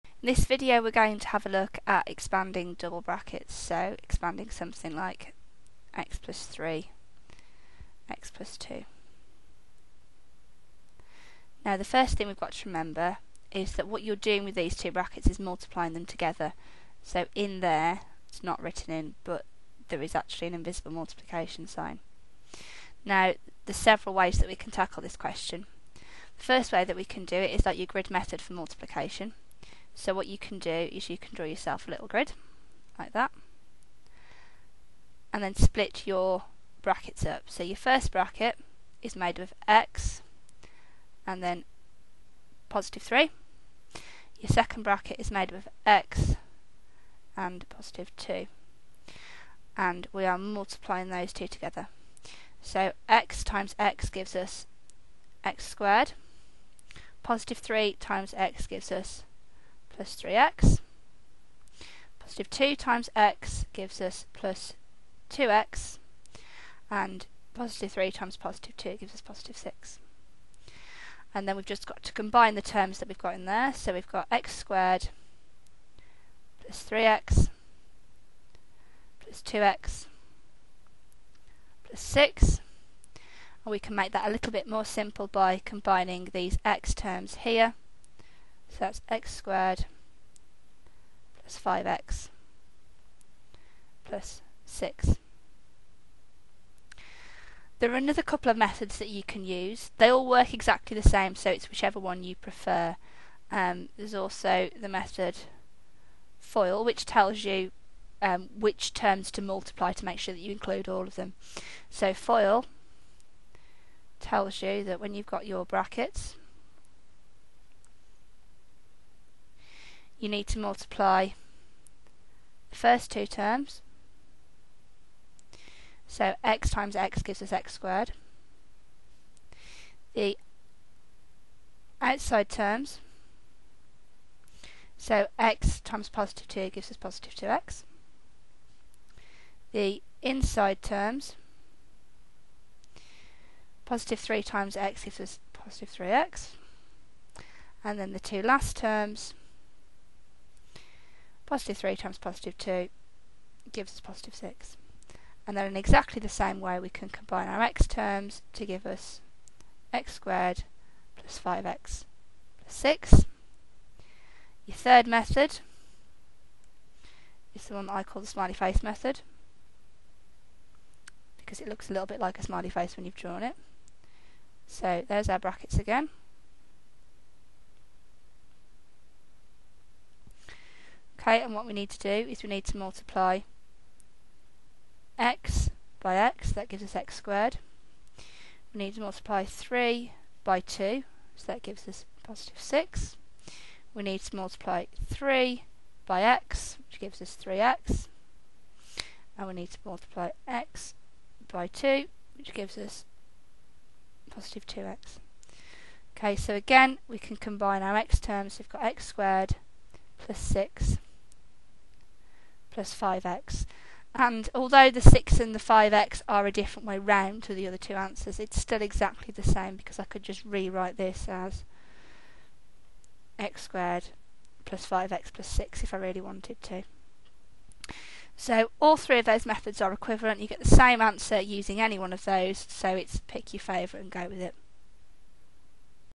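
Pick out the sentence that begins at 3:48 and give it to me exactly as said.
So all three of those methods are equivalent.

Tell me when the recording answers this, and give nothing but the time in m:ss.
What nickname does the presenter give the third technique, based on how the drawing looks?
2:48.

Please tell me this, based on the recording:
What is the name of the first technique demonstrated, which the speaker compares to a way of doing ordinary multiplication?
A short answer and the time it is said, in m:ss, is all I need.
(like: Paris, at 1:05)
grid method, at 0:27.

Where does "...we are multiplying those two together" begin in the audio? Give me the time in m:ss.
0:50.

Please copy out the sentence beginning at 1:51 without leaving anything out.
So FOIL tells you that when you've got your brackets, you need to multiply the first two terms.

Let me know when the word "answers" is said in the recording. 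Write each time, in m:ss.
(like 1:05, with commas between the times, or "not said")
3:37, 3:50.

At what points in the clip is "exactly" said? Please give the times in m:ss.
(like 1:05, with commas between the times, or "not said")
1:40, 2:35, 3:38.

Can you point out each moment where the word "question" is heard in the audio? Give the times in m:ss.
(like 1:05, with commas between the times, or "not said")
0:25.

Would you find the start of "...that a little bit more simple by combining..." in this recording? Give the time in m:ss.
1:24.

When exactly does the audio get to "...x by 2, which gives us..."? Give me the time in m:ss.
3:20.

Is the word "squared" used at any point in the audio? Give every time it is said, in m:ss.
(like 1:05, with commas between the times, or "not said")
0:55, 1:14, 1:29, 2:07, 2:40, 3:07, 3:29, 3:43.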